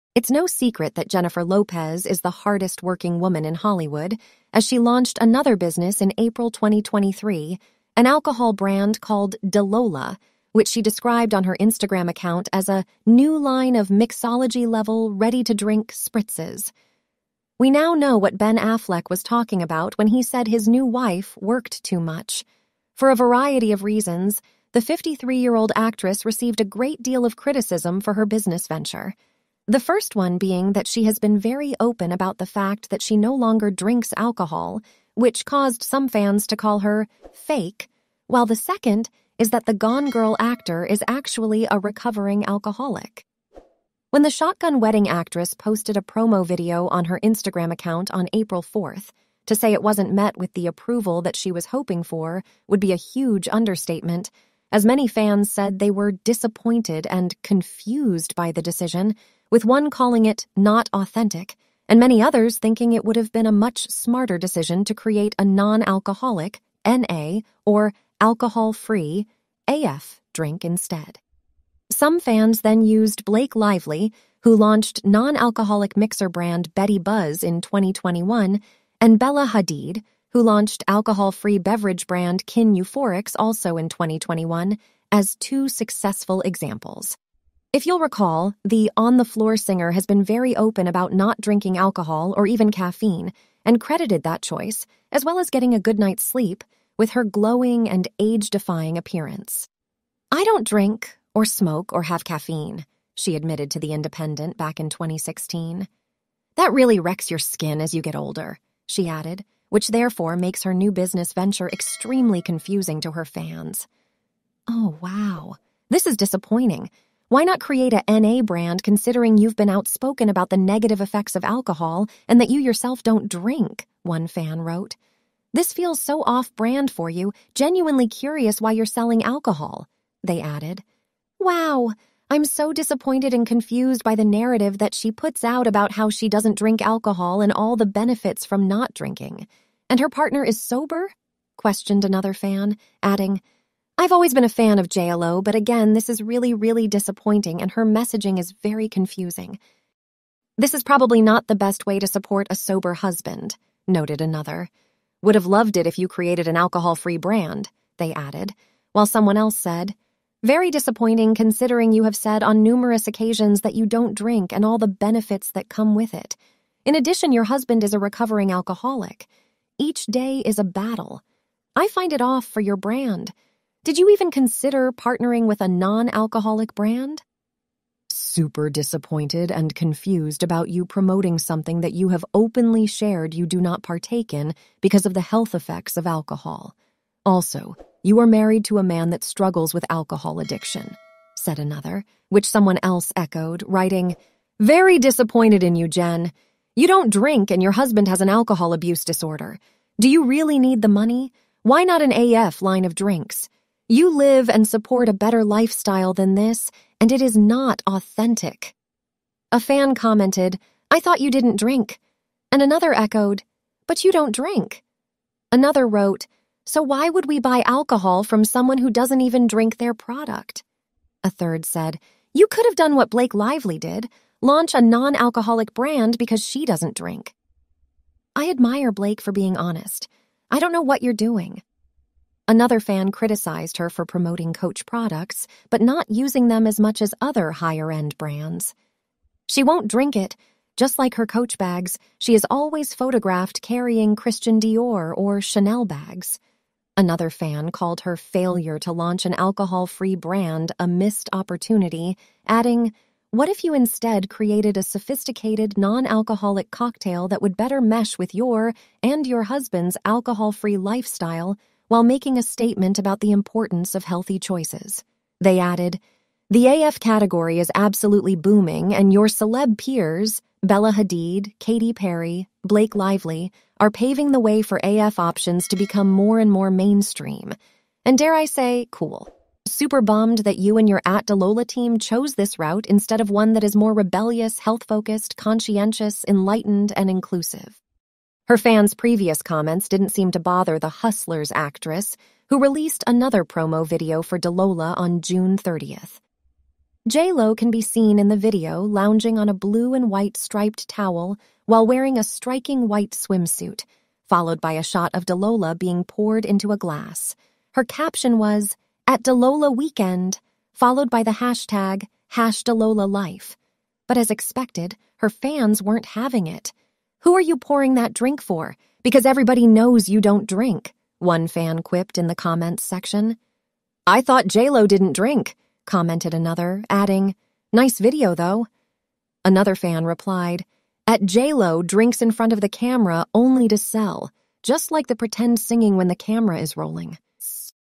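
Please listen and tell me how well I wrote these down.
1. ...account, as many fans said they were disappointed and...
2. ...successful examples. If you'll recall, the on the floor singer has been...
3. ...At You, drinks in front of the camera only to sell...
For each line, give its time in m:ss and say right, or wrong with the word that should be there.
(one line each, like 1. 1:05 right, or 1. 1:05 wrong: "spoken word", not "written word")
1. 0:53 wrong: "understatement", not "account"
2. 1:25 right
3. 5:31 wrong: "JLo", not "You".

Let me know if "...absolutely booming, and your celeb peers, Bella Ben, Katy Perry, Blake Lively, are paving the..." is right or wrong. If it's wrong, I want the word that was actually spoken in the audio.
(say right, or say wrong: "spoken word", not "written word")
wrong: "Hadid", not "Ben".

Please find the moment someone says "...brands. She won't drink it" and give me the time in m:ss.
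3:58.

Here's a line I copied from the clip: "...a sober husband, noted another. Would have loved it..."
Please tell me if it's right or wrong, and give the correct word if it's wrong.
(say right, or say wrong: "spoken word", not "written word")
right.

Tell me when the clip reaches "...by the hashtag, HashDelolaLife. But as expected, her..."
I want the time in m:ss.
5:11.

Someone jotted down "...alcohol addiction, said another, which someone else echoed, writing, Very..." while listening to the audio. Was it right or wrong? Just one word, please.
right.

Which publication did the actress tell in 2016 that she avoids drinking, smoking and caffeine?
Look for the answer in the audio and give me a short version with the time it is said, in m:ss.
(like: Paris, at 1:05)
The Independent, at 1:43.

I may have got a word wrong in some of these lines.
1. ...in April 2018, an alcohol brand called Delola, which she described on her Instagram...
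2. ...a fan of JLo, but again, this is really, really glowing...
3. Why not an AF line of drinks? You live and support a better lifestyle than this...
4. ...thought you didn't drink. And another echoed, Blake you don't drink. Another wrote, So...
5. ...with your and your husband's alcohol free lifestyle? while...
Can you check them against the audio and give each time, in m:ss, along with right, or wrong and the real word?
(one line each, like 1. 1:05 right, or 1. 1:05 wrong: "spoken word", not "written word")
1. 0:06 wrong: "2023", not "2018"
2. 2:24 wrong: "disappointing", not "glowing"
3. 3:21 right
4. 3:31 wrong: "But", not "Blake"
5. 4:18 right.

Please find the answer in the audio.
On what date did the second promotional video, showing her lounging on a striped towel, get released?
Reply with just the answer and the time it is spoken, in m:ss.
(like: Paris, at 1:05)
June 30th, at 4:55.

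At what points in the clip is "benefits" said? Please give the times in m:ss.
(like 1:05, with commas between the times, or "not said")
2:17, 2:44.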